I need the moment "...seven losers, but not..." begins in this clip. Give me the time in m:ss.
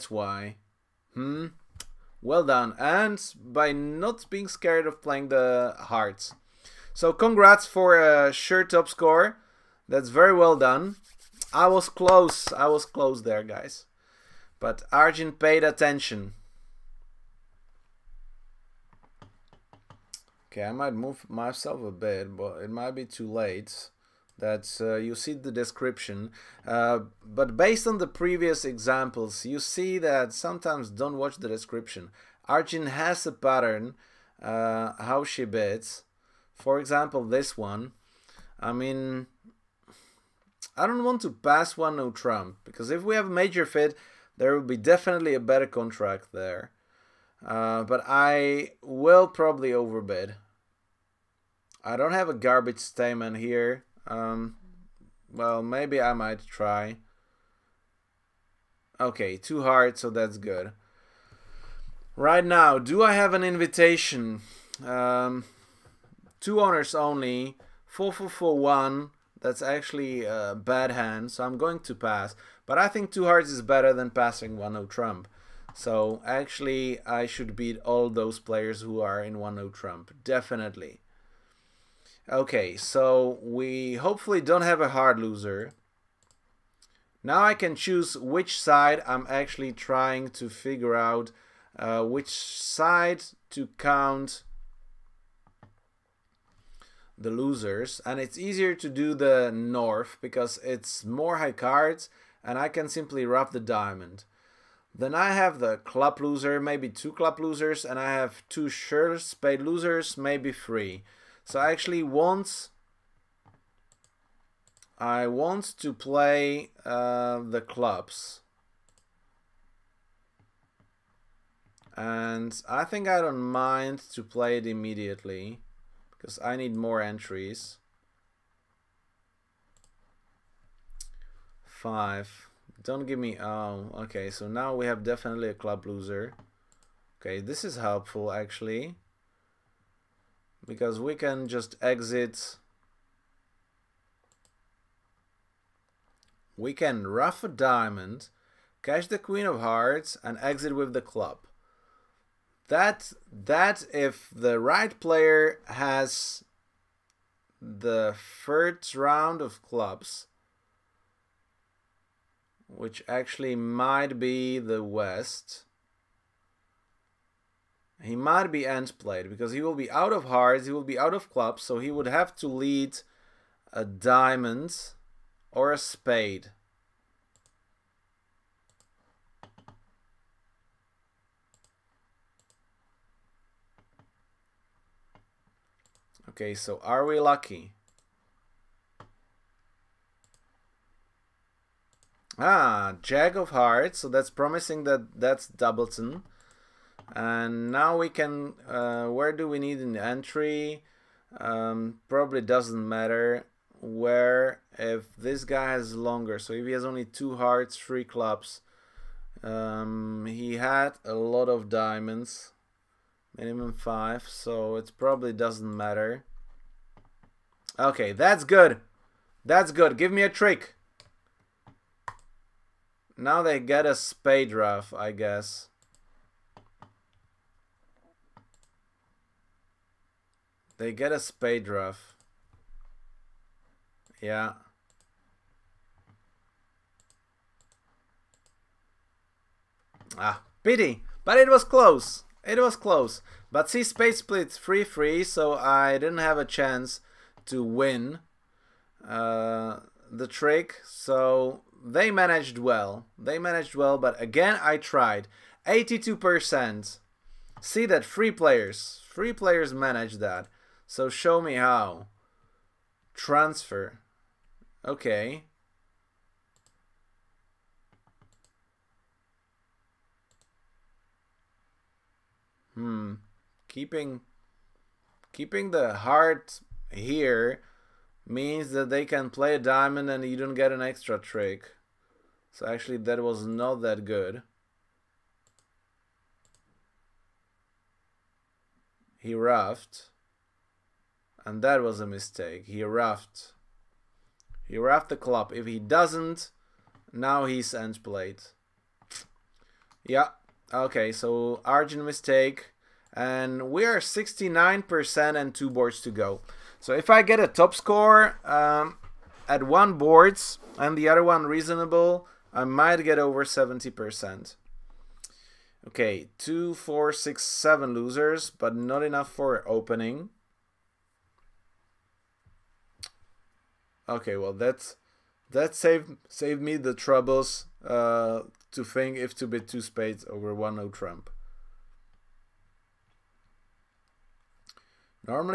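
5:17.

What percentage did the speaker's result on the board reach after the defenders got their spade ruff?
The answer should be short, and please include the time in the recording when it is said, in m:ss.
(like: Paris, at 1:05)
82%, at 4:15.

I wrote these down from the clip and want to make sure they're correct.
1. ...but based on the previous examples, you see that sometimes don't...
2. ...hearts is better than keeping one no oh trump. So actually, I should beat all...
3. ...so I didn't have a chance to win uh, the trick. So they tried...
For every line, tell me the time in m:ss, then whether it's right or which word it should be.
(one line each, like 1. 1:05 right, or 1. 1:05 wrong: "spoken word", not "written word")
1. 0:27 right
2. 1:13 wrong: "passing", not "keeping"
3. 4:05 wrong: "managed", not "tried".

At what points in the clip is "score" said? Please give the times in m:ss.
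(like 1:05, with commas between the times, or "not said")
0:08, 5:07.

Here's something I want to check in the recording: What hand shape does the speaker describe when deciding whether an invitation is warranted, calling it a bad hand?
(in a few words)
4441.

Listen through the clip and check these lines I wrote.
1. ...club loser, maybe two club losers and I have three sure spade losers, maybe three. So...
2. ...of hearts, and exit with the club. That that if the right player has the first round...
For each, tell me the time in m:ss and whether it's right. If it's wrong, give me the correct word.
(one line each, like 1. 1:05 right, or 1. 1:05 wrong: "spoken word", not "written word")
1. 1:45 wrong: "two", not "three"
2. 2:29 right.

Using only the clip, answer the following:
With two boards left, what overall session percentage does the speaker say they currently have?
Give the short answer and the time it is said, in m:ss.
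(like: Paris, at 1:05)
69%, at 5:03.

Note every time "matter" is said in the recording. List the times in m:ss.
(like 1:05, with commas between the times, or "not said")
3:22, 3:35.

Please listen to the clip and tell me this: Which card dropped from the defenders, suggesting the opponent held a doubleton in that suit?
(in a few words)
Jack of Hearts.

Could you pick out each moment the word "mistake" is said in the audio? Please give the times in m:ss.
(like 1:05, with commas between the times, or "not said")
4:52, 5:02.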